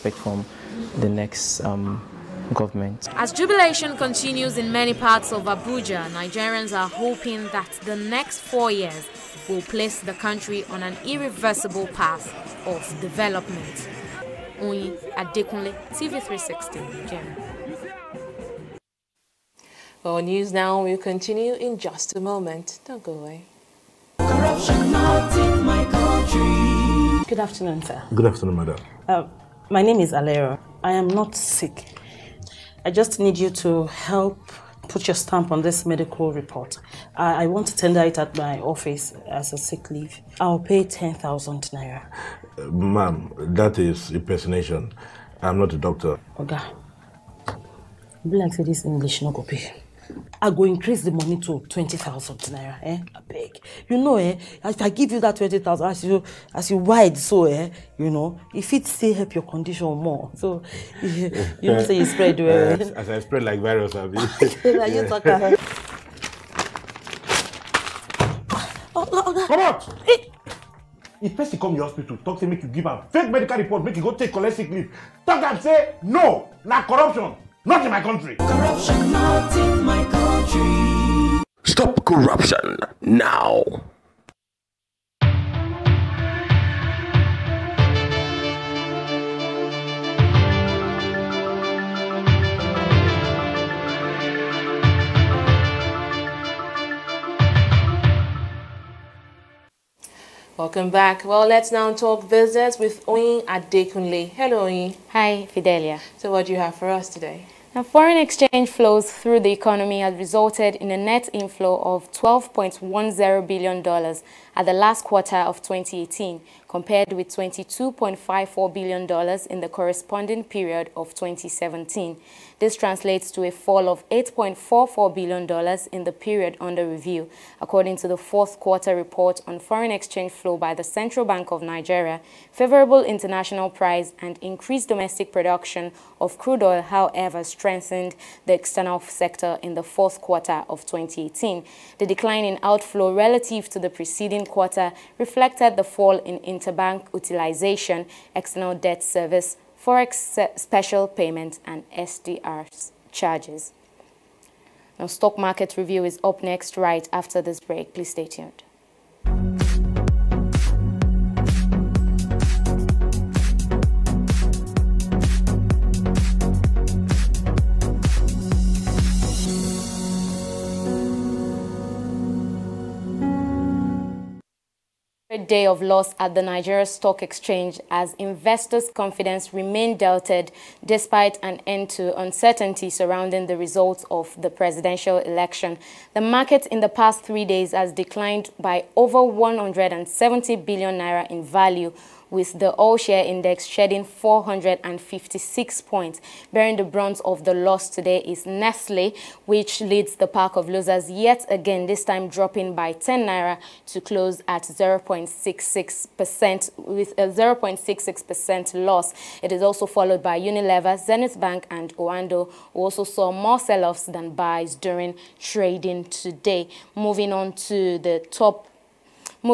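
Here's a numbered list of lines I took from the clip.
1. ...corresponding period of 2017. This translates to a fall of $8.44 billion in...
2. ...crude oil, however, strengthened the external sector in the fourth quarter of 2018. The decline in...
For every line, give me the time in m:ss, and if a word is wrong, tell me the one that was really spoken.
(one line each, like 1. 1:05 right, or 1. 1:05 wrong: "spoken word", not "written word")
1. 1:59 right
2. 2:16 right.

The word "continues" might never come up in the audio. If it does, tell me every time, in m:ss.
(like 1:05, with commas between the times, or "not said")
0:03, 0:20.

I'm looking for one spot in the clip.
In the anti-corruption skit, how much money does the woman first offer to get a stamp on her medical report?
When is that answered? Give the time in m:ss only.
0:40.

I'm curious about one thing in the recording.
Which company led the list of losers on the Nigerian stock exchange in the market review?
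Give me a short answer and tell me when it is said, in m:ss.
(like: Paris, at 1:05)
Nestle, at 3:18.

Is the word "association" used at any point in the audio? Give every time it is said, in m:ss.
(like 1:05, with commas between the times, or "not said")
not said.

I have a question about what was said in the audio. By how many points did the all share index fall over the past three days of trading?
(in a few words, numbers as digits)
456.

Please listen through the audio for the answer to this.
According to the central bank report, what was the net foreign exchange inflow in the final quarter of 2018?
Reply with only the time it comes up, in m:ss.
1:52.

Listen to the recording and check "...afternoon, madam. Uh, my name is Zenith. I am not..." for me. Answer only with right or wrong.
wrong.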